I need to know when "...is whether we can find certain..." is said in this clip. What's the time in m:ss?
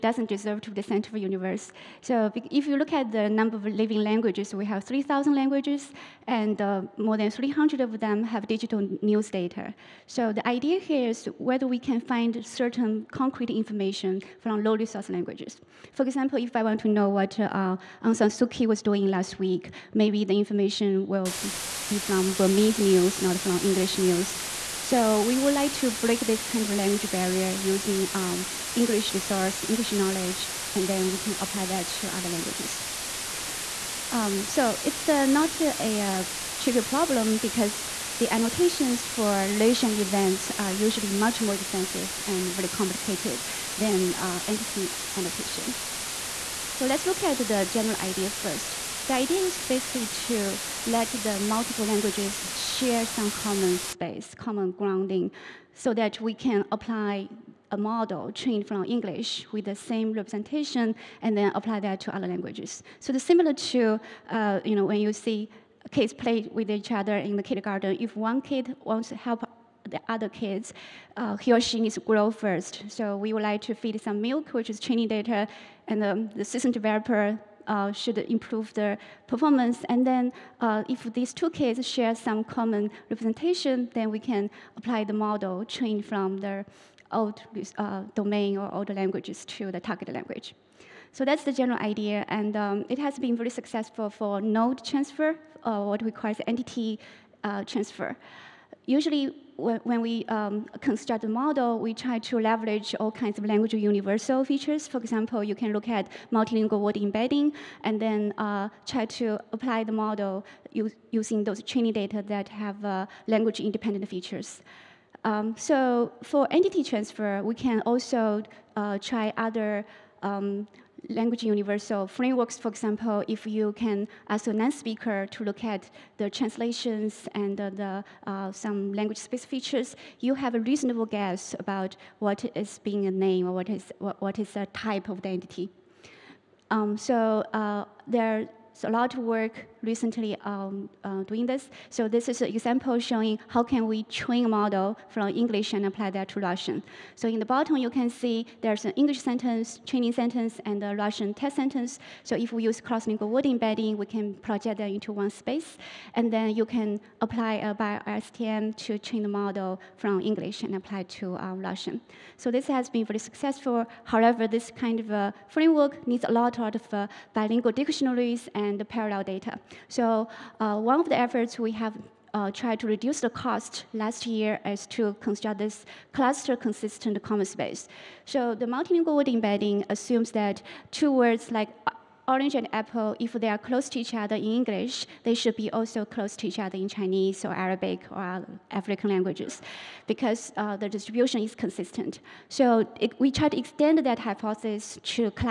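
0:11.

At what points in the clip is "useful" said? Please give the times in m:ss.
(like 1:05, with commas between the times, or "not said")
not said.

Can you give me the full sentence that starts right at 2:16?
Um, so uh, there's a lot of work recently um, uh, doing this.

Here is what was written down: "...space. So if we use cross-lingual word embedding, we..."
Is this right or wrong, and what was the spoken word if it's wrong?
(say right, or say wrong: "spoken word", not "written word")
wrong: "sentence", not "space".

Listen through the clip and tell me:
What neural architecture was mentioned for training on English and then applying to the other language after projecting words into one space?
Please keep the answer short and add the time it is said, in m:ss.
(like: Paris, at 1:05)
BiLSTM, at 2:37.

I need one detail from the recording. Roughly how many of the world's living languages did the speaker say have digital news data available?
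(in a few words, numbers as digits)
300.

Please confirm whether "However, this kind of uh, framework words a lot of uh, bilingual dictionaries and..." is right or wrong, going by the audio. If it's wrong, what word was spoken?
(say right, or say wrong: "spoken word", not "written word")
wrong: "needs", not "words".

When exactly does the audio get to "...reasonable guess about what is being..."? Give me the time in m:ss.
2:10.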